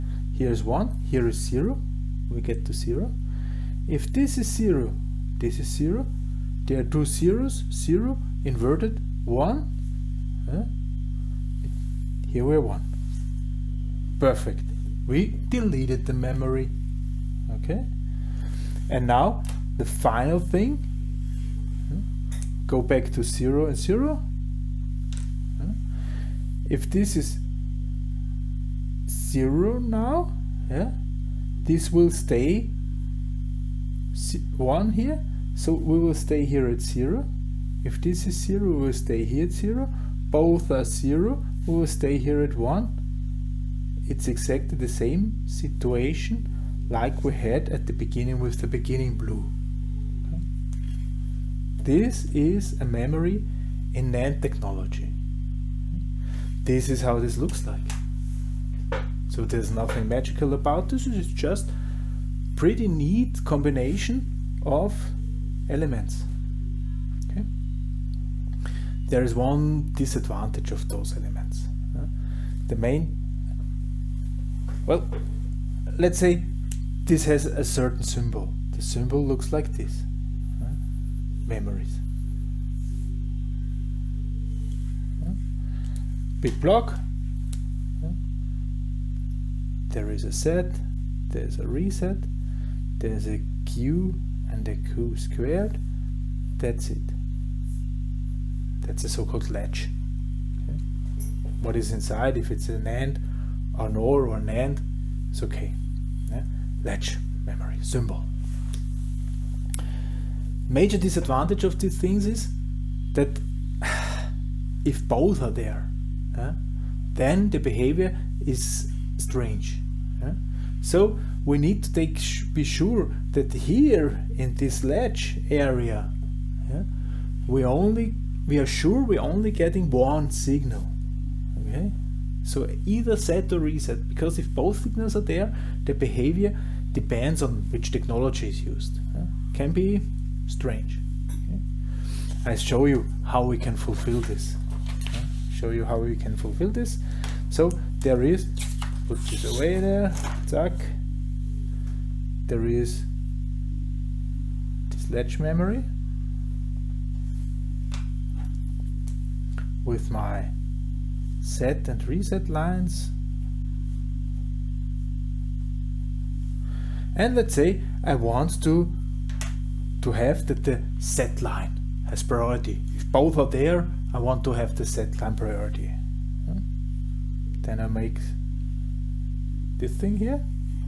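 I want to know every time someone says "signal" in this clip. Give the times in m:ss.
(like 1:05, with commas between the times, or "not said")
2:10, 2:14.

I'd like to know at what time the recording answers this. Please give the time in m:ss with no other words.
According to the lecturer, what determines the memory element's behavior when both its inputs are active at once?
2:17.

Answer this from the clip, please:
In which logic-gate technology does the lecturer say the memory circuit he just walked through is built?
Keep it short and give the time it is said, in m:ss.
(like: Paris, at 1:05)
NAND technology, at 0:54.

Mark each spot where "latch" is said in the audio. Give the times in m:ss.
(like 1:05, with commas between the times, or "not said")
1:39, 1:46, 2:04, 2:35.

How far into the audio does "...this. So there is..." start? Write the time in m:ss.
2:26.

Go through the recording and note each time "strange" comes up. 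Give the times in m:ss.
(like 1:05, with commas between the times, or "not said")
1:59, 2:20.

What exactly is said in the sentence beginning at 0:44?
It's exactly the same situation like we had at the beginning with the beginning blue.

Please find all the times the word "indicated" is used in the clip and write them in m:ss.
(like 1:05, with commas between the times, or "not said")
not said.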